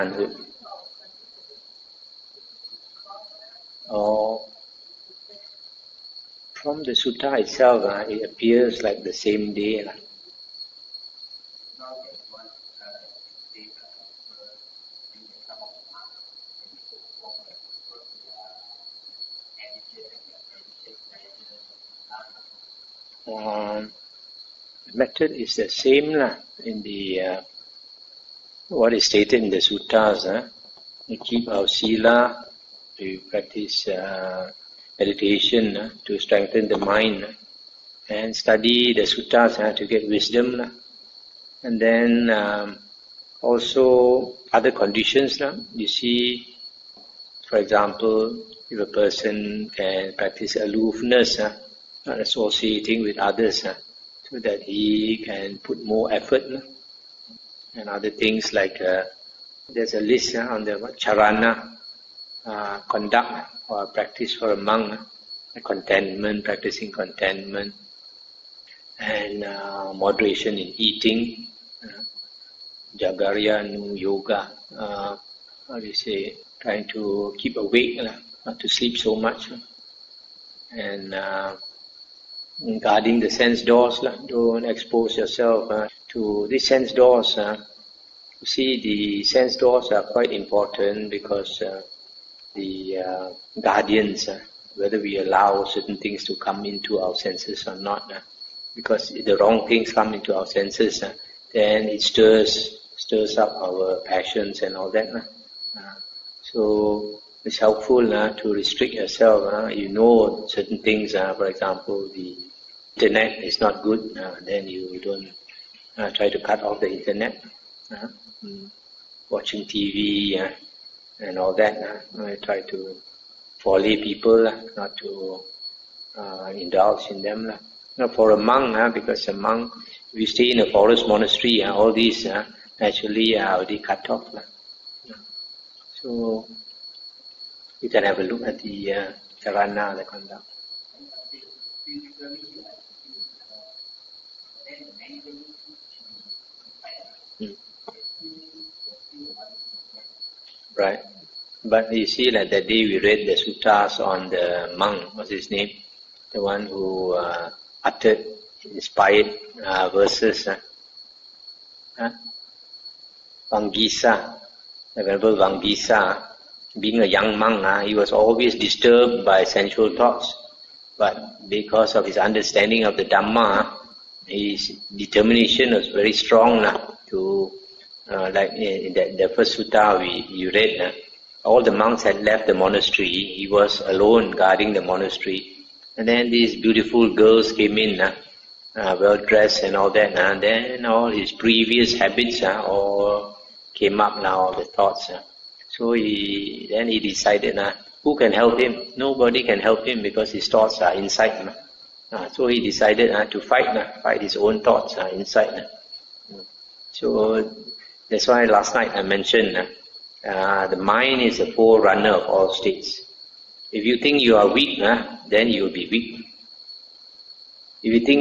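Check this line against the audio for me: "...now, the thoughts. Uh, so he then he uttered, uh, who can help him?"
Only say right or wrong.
wrong.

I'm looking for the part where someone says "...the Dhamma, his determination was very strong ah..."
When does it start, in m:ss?
2:52.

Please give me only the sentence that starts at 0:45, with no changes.
You see, for example, if a person can practice aloofness, not associating with others, that he can put more effort no?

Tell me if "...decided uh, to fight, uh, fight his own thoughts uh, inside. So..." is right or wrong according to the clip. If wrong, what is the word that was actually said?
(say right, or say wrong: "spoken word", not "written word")
right.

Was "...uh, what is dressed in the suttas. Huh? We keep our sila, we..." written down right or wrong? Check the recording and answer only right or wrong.
wrong.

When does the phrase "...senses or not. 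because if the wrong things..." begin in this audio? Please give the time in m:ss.
1:37.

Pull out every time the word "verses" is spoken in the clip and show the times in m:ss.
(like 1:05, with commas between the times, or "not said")
2:39.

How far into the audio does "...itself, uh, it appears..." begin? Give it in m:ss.
0:07.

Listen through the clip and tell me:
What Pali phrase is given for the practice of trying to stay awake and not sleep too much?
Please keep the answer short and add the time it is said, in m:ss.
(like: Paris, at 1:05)
jagarya yoga, at 1:12.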